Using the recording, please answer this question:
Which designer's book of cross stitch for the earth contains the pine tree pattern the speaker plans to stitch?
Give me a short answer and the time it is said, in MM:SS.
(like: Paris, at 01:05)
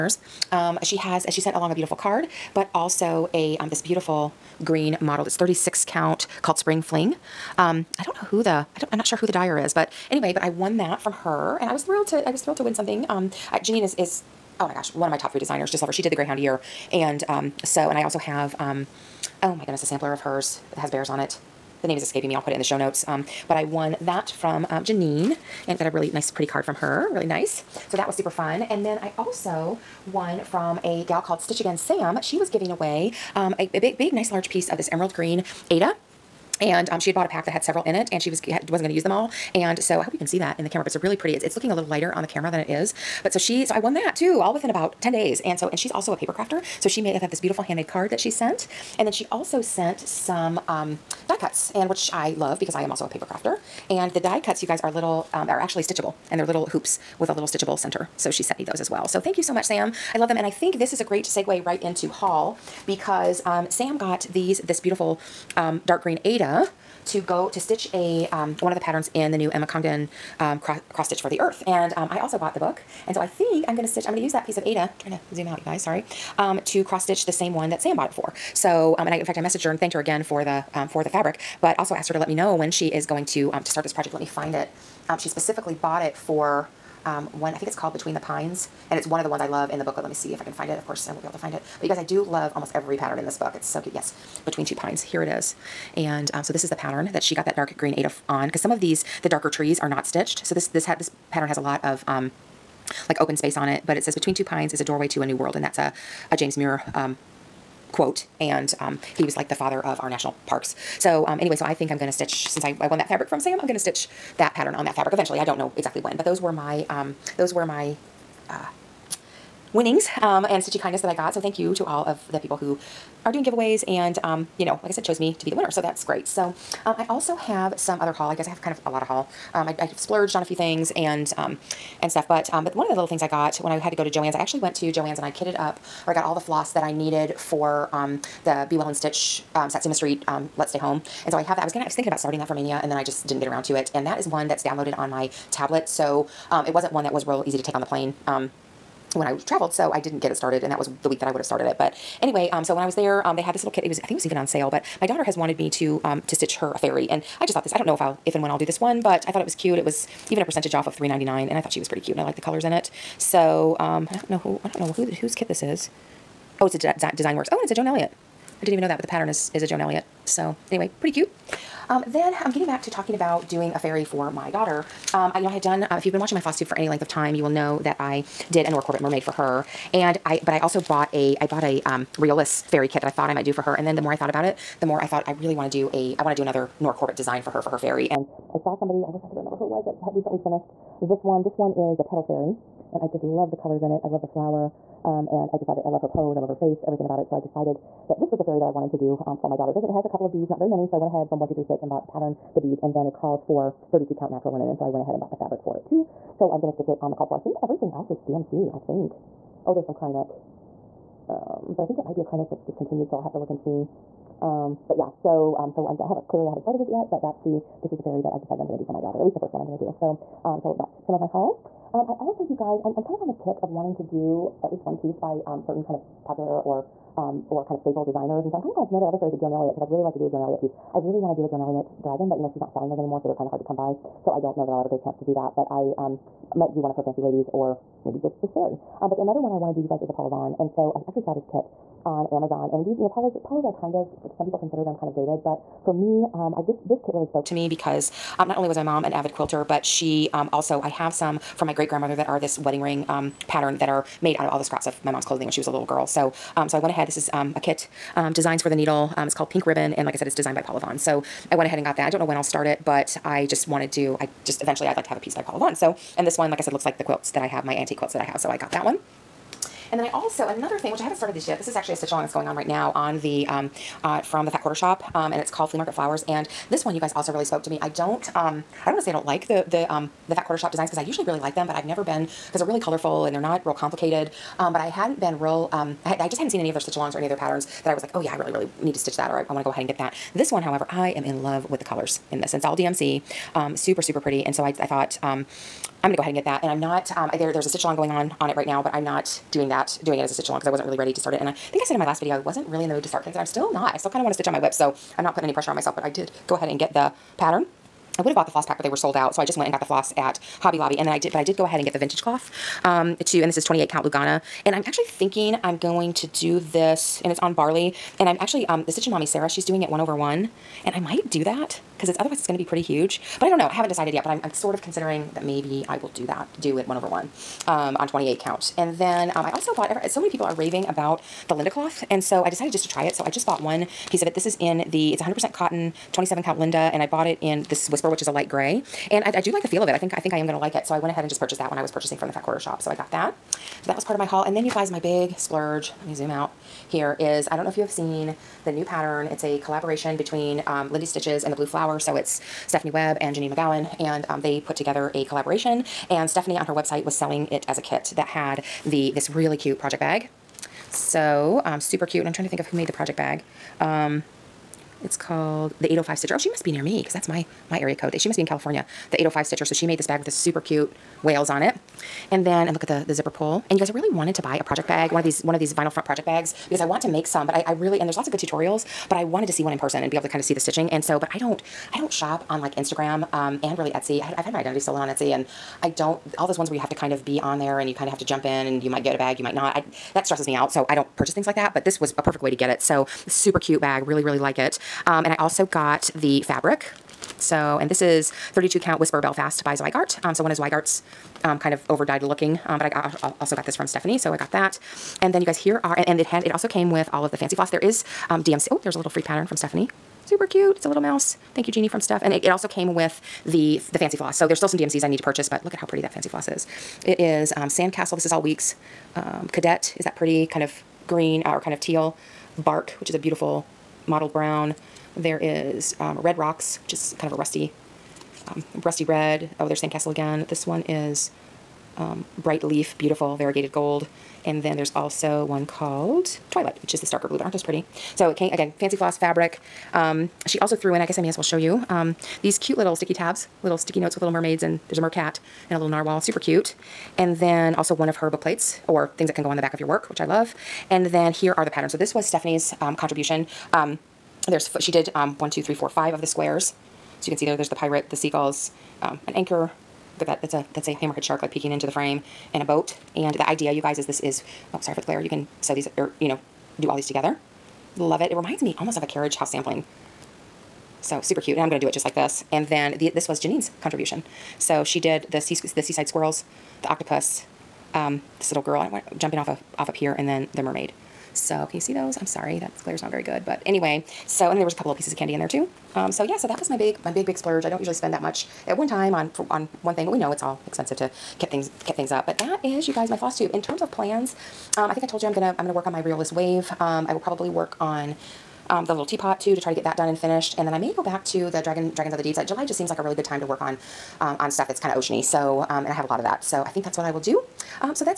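Emma Congdon, at 01:09.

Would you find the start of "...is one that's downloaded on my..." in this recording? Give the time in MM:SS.
02:24.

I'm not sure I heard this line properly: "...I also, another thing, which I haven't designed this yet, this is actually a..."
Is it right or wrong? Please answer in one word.
wrong.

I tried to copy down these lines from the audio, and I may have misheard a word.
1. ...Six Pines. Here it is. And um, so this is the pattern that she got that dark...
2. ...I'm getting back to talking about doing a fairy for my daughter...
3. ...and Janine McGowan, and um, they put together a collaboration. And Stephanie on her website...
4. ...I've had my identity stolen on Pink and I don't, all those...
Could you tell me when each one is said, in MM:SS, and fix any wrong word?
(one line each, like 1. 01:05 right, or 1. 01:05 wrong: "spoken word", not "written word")
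1. 01:34 wrong: "Two", not "Six"
2. 02:52 right
3. 05:53 right
4. 06:24 wrong: "Etsy", not "Pink".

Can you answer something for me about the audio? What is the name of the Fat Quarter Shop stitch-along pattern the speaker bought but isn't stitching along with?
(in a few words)
Flea Market Flowers.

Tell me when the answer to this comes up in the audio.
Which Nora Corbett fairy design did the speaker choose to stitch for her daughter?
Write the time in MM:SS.
03:12.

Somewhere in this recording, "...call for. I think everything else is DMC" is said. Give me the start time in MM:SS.
03:27.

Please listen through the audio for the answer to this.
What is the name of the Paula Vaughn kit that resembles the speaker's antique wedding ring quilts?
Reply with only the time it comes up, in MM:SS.
04:19.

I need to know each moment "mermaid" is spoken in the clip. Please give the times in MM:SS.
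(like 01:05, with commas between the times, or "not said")
02:58, 07:24, 08:00.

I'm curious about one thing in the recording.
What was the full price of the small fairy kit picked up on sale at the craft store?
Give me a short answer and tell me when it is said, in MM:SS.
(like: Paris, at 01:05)
$3.99, at 02:40.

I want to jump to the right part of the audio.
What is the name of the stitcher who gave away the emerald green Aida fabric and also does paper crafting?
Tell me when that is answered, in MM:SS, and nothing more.
00:31.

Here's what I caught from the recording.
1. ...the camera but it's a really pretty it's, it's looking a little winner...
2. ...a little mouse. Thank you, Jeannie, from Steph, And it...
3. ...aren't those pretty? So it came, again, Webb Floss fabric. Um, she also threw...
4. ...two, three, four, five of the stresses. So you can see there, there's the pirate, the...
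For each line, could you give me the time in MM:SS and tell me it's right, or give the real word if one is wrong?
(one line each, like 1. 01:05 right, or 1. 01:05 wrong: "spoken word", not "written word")
1. 00:40 wrong: "lighter", not "winner"
2. 06:50 right
3. 07:17 wrong: "Fancy", not "Webb"
4. 07:35 wrong: "squares", not "stresses".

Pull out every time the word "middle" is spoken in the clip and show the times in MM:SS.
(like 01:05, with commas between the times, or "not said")
not said.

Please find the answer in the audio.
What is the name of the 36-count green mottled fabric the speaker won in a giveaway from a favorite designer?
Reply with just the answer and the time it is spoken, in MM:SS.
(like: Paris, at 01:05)
Spring Fling, at 00:06.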